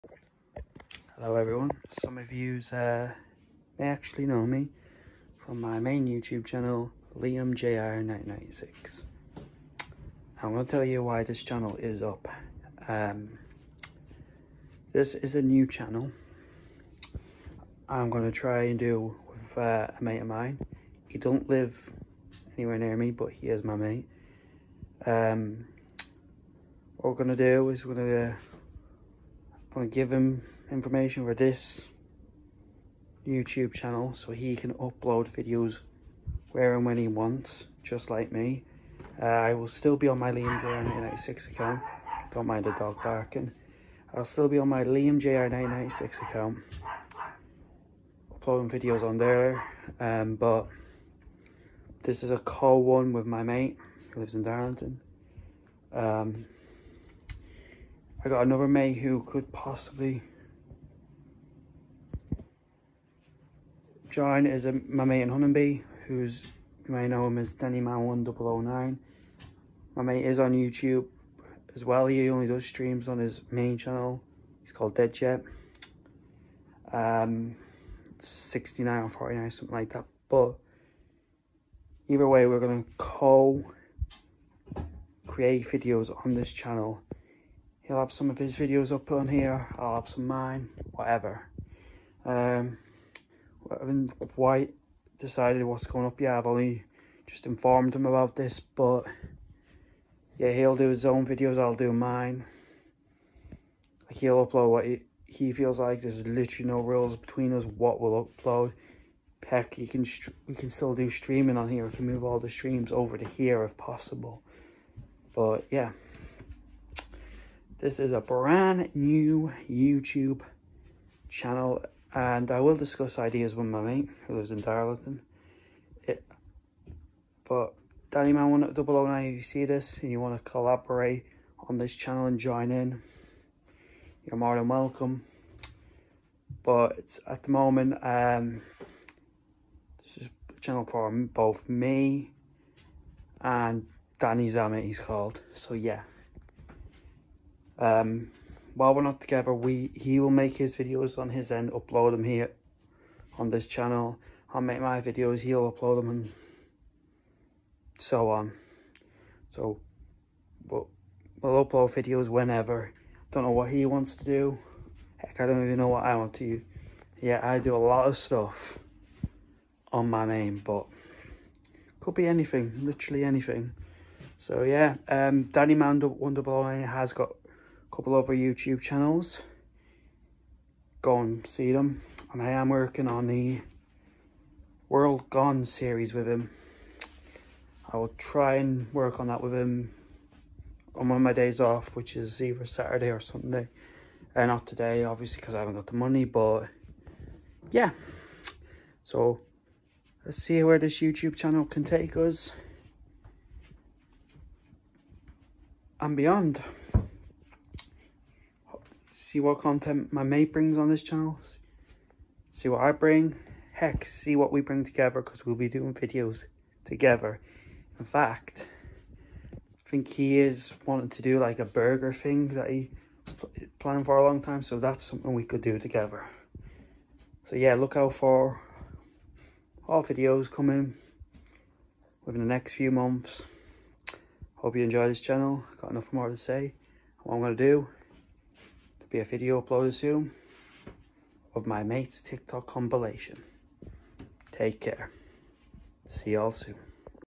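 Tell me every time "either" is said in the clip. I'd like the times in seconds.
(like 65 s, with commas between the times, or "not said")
82 s, 192 s.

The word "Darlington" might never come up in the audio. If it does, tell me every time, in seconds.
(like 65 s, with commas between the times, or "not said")
54 s, 124 s.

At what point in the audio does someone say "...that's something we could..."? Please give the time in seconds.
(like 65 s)
224 s.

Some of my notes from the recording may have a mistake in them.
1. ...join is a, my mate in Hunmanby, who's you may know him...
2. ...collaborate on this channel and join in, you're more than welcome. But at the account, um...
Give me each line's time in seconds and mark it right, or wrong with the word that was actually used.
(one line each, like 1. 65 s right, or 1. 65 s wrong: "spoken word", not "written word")
1. 64 s right
2. 130 s wrong: "moment", not "account".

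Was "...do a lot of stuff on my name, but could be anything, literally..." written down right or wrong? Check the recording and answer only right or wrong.
right.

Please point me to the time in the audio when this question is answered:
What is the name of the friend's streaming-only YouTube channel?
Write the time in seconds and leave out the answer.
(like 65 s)
74 s.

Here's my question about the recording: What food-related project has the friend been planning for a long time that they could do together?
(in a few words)
A burger thing.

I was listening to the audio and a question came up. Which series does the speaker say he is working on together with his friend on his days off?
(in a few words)
World Gone.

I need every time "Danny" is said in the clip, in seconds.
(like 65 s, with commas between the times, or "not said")
67 s, 128 s, 144 s, 175 s.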